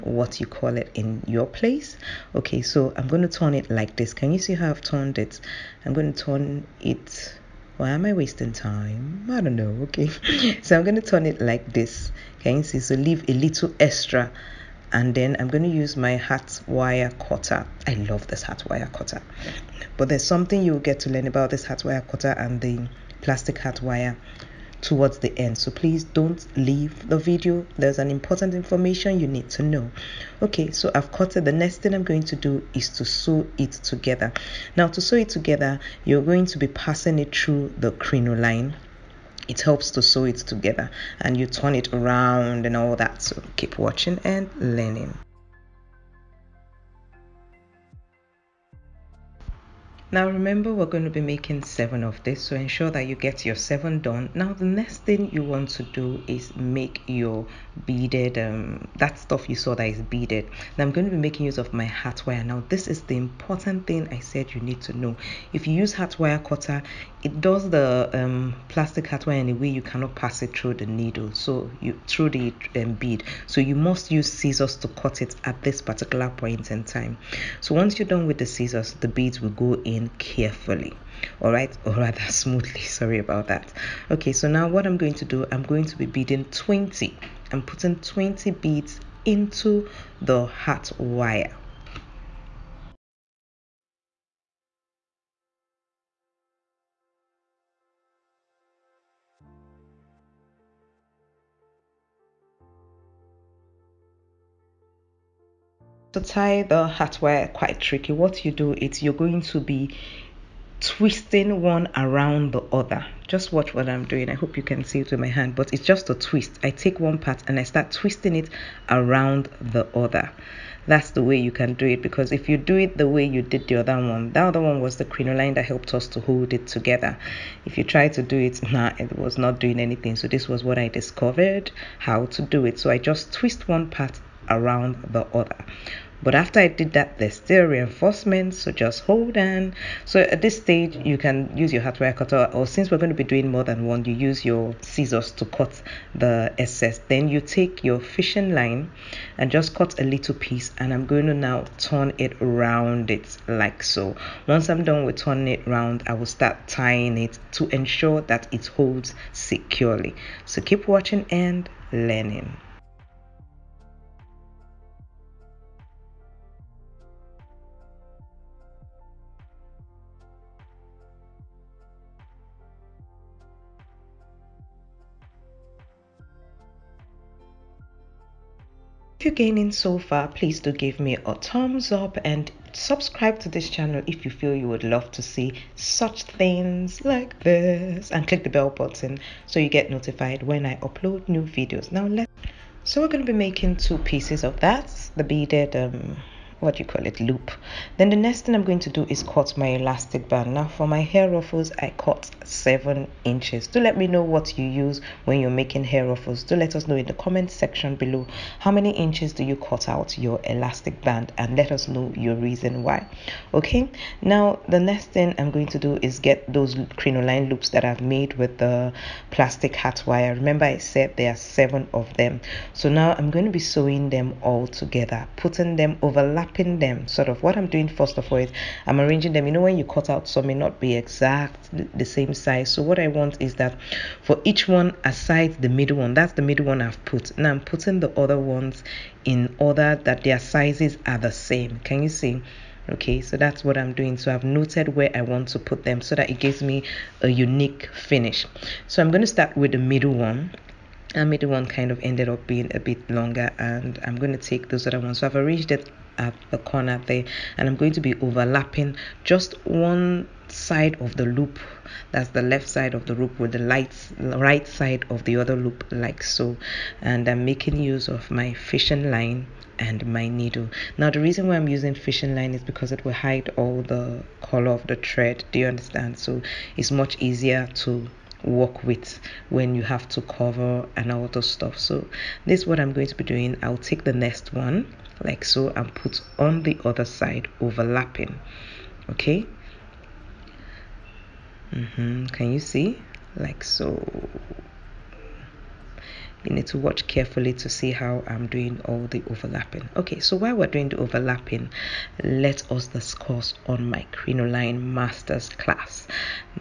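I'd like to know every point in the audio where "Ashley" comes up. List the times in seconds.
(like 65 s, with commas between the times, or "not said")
not said.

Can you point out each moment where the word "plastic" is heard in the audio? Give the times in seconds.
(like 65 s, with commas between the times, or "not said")
23 s, 68 s, 219 s.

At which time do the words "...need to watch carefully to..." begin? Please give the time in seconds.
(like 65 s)
296 s.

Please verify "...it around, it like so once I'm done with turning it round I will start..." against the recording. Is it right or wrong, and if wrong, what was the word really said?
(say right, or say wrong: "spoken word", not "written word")
right.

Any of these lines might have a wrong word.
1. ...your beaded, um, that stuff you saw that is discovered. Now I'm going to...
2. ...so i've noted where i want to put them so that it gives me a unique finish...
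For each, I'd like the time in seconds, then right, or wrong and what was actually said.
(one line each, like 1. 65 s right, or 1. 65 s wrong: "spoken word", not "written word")
1. 57 s wrong: "beaded", not "discovered"
2. 244 s right.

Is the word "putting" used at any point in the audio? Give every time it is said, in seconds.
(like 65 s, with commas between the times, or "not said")
87 s, 225 s, 237 s.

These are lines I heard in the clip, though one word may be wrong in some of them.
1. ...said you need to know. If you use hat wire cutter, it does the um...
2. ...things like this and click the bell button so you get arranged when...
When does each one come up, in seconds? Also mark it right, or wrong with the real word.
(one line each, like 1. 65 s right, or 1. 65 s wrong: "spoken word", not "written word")
1. 64 s right
2. 186 s wrong: "notified", not "arranged".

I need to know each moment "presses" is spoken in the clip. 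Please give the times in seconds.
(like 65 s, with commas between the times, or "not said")
not said.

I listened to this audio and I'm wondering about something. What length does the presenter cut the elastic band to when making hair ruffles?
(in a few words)
7 inches.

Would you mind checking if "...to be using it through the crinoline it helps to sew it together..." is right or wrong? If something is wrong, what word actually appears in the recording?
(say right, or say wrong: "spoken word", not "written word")
wrong: "passing", not "using".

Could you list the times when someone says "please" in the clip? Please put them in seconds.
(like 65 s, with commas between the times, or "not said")
25 s, 180 s.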